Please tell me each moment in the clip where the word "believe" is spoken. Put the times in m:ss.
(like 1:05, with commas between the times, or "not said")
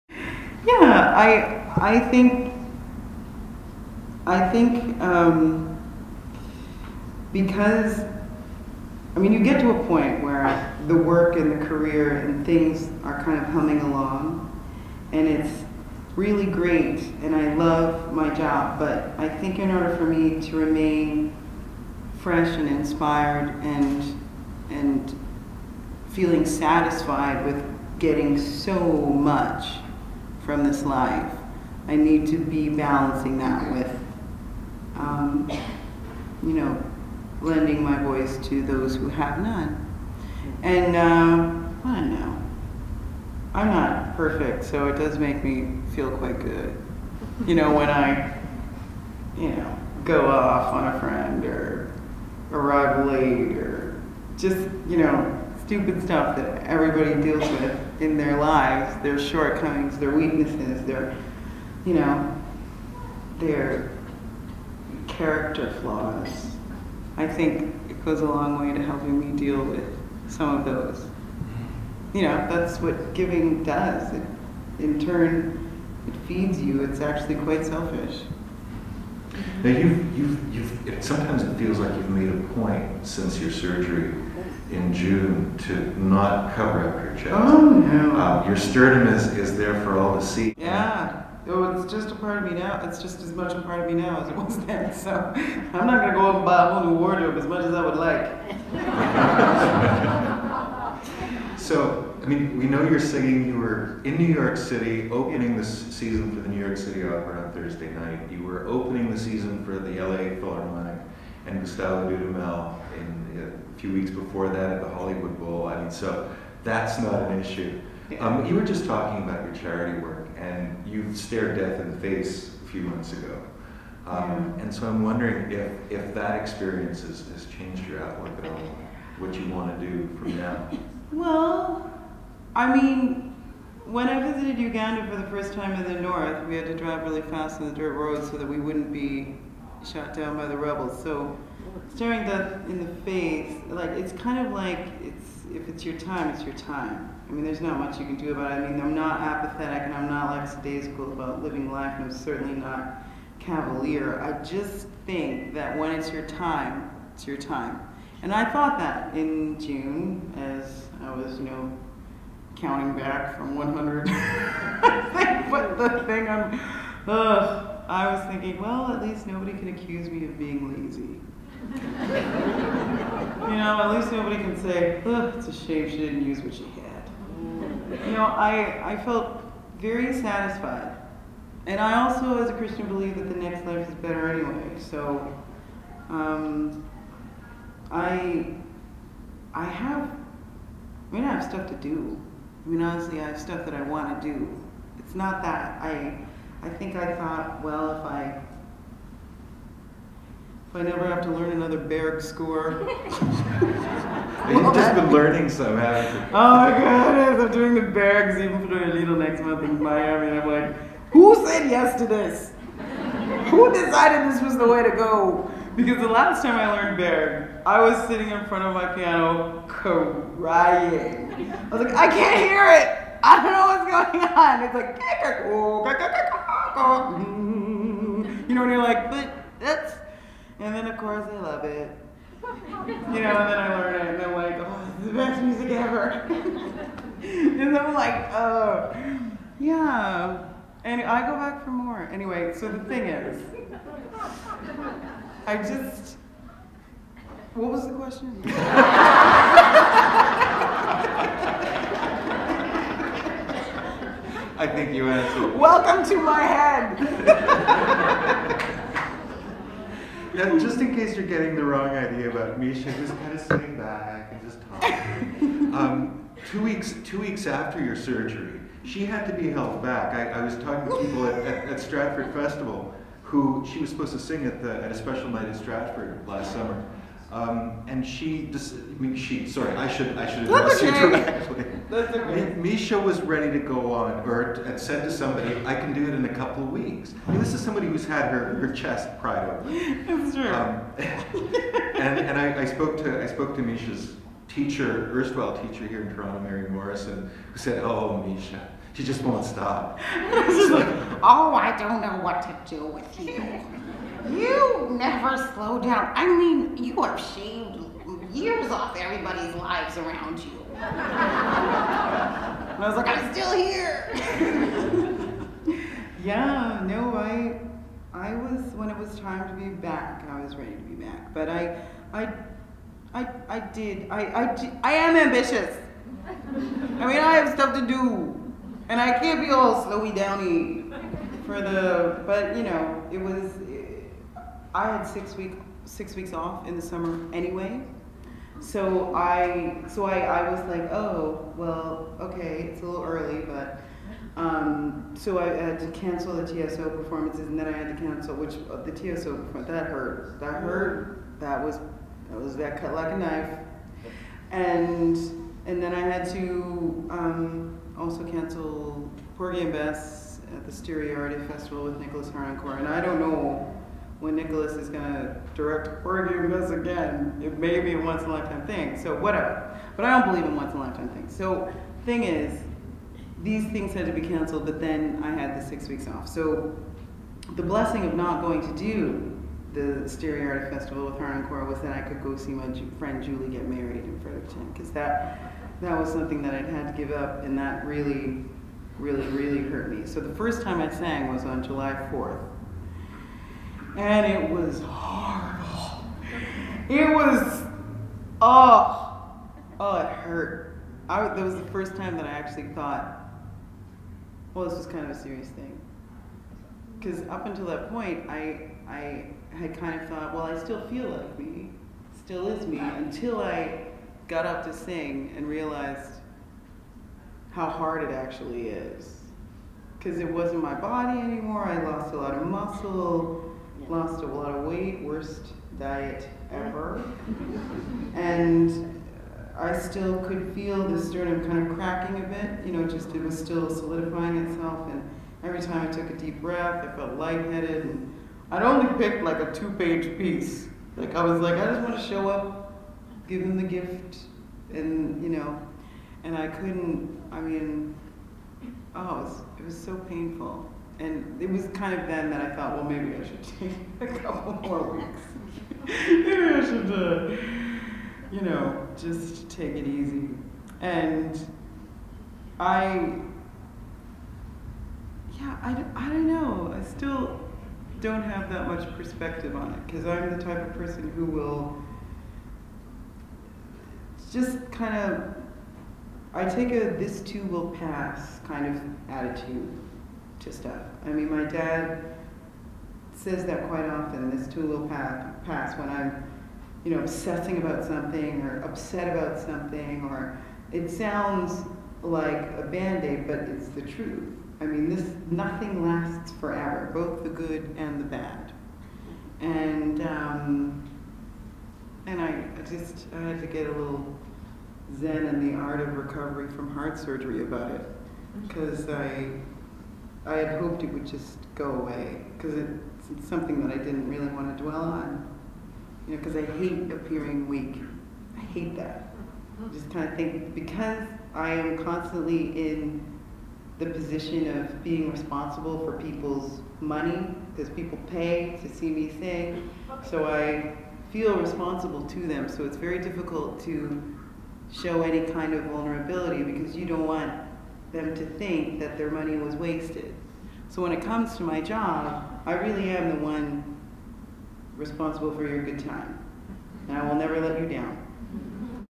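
3:02, 6:10.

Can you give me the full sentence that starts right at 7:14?
And every time I took a deep breath, I felt lightheaded.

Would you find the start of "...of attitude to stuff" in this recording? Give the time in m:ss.
7:58.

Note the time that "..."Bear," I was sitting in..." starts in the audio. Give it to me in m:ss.
3:36.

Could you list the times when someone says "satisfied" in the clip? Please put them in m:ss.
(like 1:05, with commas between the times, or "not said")
0:26, 3:00.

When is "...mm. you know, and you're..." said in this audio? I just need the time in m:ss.
3:47.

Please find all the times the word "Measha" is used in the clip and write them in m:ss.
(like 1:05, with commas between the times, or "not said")
4:22, 4:42, 4:53, 4:58.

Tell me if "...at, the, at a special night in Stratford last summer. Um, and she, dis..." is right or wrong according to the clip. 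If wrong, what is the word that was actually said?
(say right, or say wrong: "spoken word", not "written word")
right.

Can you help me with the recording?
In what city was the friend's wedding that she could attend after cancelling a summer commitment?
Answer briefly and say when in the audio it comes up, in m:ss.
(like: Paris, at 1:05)
Fredericton, at 6:24.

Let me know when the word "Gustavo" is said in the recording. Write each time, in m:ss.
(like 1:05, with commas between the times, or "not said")
1:51.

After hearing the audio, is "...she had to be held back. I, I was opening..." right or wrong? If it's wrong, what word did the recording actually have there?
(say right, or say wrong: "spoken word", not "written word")
wrong: "talking", not "opening".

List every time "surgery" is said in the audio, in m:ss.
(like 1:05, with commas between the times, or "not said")
1:23, 4:27, 8:26.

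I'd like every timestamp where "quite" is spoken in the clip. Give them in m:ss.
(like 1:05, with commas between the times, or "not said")
0:46, 1:17, 8:03.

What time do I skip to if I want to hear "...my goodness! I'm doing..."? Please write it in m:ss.
3:26.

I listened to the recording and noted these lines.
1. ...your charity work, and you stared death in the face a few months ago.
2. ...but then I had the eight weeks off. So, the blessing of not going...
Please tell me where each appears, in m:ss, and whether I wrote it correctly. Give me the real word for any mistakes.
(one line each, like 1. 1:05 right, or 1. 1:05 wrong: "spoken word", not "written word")
1. 1:59 right
2. 6:14 wrong: "six", not "eight".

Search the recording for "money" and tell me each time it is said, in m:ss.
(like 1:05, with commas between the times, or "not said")
8:46, 8:59.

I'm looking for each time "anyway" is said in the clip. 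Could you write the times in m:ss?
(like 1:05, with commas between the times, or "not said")
3:04, 4:02, 5:37.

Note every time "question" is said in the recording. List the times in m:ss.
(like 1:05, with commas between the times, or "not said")
4:07.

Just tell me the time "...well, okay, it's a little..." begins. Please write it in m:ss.
5:41.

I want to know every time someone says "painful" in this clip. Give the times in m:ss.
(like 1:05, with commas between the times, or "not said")
7:29.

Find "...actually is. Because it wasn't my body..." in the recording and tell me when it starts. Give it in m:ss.
6:58.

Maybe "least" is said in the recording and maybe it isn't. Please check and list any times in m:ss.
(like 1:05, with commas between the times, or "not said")
2:49, 2:53.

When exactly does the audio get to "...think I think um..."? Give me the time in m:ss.
0:02.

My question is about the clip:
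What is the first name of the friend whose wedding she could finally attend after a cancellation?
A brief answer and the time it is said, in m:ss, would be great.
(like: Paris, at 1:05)
Julie, at 6:23.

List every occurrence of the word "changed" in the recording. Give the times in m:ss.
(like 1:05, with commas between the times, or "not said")
2:07.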